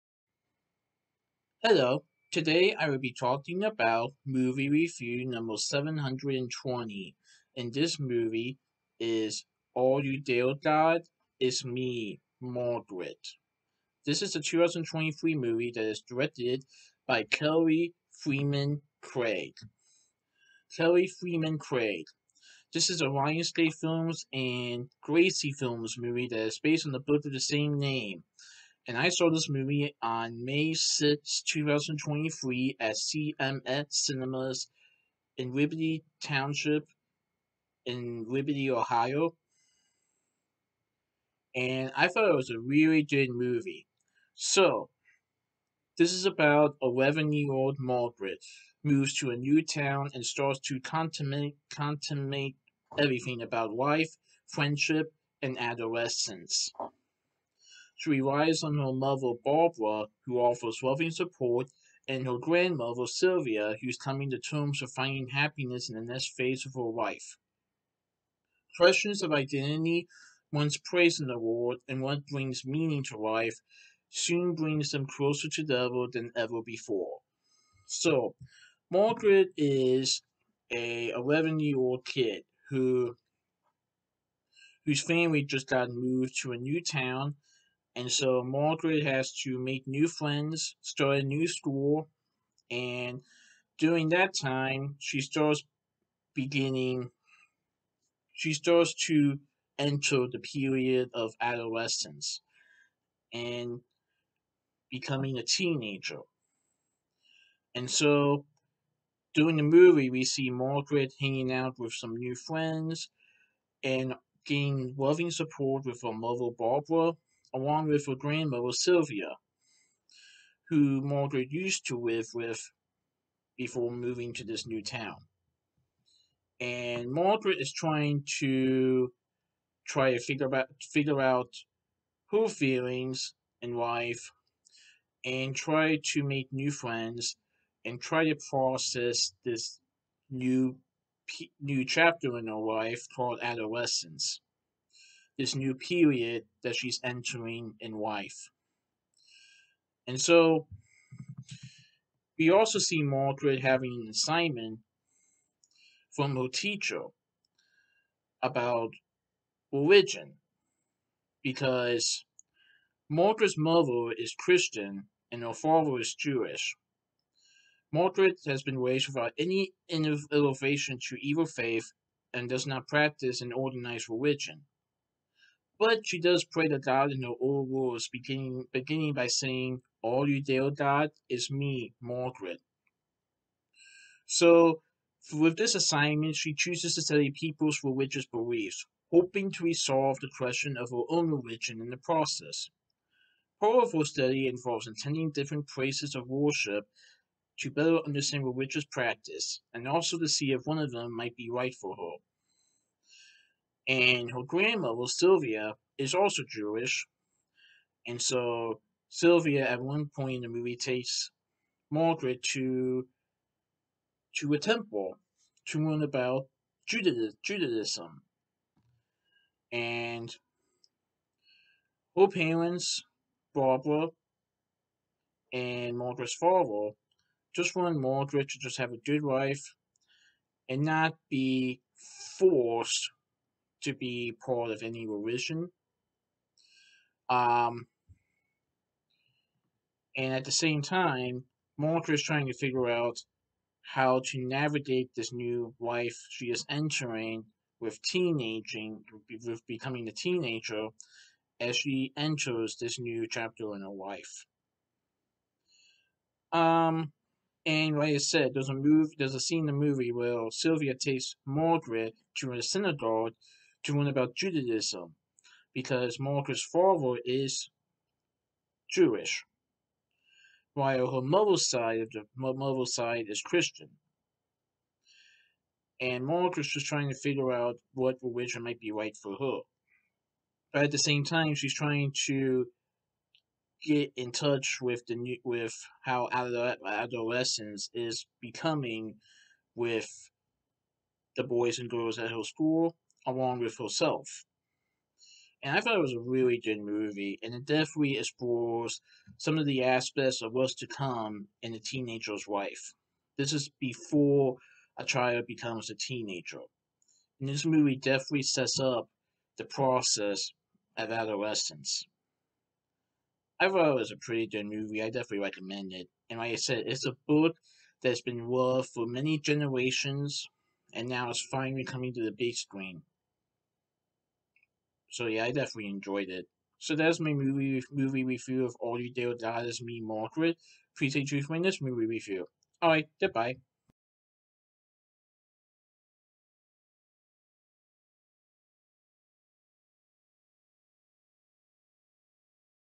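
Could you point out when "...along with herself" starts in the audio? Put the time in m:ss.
4:53.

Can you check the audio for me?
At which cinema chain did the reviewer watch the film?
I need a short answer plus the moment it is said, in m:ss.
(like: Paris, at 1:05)
CMX Cinemas, at 0:32.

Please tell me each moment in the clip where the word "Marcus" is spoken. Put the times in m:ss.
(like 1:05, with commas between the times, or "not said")
4:26, 4:36.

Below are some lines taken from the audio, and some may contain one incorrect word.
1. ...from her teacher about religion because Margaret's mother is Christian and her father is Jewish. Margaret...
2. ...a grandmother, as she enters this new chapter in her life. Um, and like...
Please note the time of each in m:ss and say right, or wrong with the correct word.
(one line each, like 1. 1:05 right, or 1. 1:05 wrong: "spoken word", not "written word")
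1. 2:36 right
2. 4:10 wrong: "teenager", not "grandmother".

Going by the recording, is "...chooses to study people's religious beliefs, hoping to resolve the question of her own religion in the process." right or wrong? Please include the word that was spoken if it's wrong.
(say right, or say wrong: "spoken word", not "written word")
right.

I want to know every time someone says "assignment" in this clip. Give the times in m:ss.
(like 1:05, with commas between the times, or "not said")
2:34, 3:05.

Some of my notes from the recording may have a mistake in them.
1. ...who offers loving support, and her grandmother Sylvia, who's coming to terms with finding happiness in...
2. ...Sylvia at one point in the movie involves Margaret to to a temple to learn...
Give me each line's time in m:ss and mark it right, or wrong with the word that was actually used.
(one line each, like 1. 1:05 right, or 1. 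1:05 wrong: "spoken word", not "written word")
1. 1:00 right
2. 3:29 wrong: "takes", not "involves".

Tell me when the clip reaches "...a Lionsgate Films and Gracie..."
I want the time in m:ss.
0:23.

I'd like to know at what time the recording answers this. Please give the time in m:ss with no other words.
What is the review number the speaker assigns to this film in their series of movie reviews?
0:05.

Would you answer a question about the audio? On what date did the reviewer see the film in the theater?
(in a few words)
May 6, 2023.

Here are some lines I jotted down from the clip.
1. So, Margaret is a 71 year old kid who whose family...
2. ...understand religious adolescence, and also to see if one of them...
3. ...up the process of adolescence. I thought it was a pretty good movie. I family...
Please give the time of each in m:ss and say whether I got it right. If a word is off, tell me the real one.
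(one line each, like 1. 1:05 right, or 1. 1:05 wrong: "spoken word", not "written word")
1. 1:17 wrong: "11", not "71"
2. 3:18 wrong: "practice", not "adolescence"
3. 5:08 wrong: "definitely", not "family".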